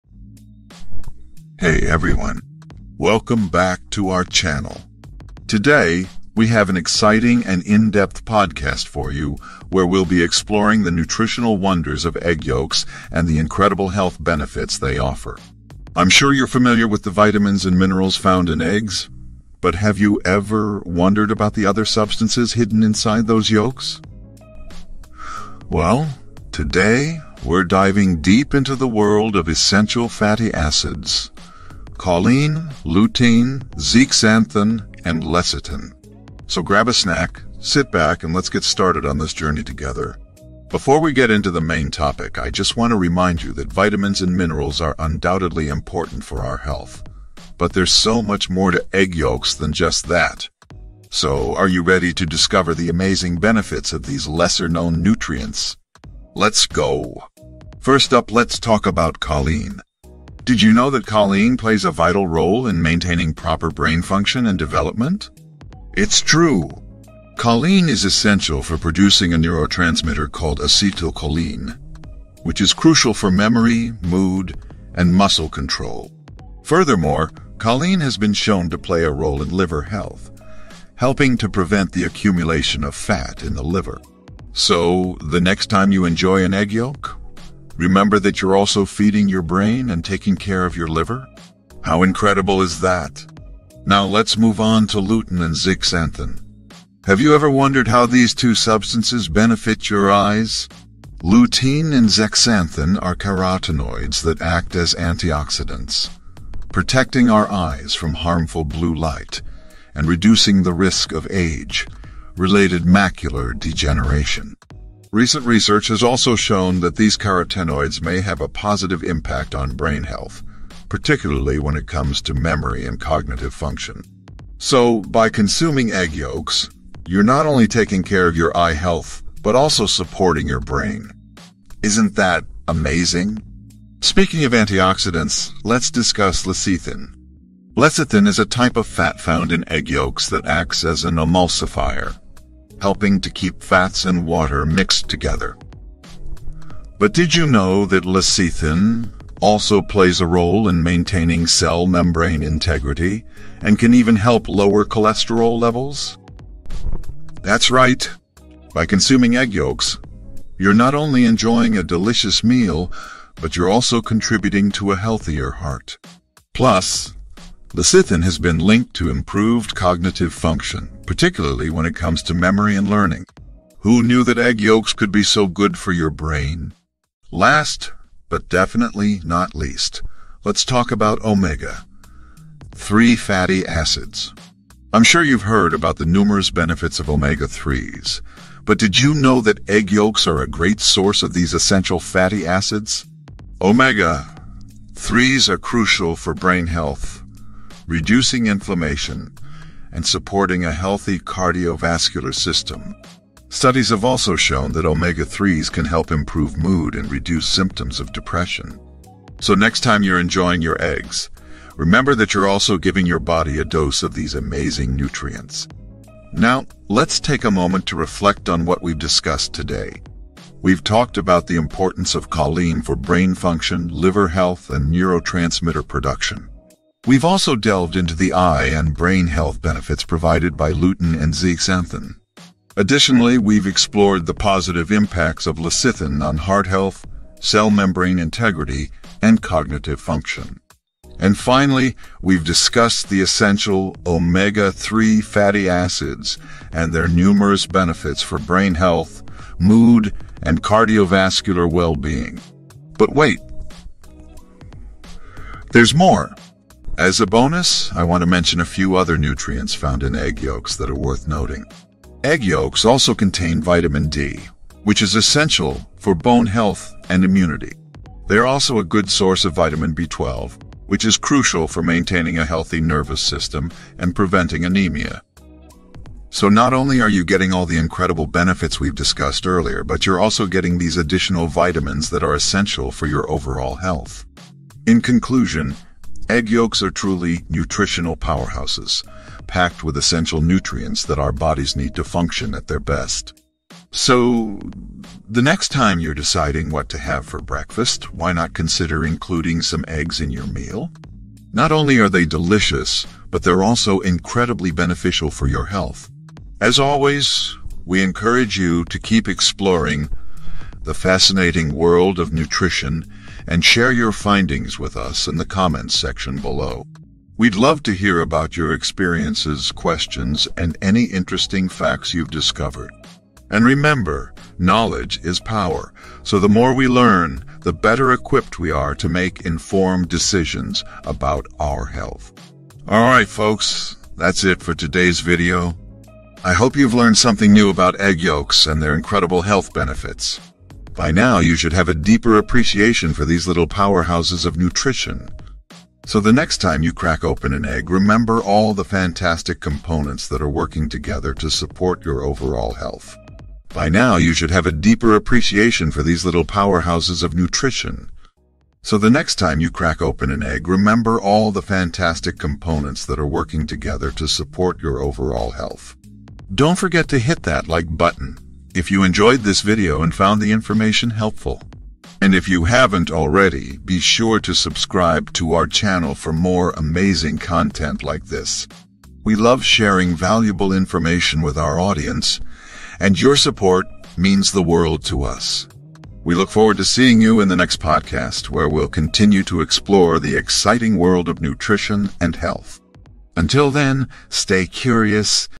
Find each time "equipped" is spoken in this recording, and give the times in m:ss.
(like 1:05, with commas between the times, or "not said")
5:28.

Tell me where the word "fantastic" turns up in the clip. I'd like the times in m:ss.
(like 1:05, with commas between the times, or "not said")
5:48, 6:01.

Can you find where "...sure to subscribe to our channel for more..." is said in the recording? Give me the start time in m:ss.
6:13.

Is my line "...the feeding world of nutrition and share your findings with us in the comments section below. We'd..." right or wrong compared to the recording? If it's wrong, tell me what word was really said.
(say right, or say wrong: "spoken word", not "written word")
wrong: "fascinating", not "feeding".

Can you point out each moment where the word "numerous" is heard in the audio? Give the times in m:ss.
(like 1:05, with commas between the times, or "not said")
3:06, 4:07.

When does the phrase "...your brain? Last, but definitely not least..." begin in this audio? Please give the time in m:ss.
2:55.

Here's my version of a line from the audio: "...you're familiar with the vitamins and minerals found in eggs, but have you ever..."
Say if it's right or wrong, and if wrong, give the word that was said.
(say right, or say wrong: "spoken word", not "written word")
right.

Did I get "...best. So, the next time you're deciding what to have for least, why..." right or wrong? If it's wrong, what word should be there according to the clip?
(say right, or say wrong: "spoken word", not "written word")
wrong: "breakfast", not "least".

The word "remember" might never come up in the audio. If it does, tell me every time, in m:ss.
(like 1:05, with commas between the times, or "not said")
1:27, 3:31, 5:23, 5:47, 6:00.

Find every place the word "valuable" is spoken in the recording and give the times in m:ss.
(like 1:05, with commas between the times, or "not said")
6:20.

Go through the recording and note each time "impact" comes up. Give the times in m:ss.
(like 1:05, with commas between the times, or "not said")
1:59, 3:54.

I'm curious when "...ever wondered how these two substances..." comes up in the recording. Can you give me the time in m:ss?
1:37.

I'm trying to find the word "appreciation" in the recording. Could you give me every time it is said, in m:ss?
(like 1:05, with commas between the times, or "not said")
5:42, 5:55.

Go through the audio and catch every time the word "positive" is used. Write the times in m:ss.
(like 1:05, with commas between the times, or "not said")
1:58, 3:54.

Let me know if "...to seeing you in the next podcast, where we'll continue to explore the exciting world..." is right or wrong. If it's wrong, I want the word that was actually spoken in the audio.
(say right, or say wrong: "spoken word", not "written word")
right.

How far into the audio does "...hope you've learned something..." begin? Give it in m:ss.
5:36.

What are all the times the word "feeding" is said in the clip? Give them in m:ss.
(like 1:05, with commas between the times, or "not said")
1:28.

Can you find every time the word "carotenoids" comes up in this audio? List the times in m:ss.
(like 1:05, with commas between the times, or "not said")
1:43, 1:57.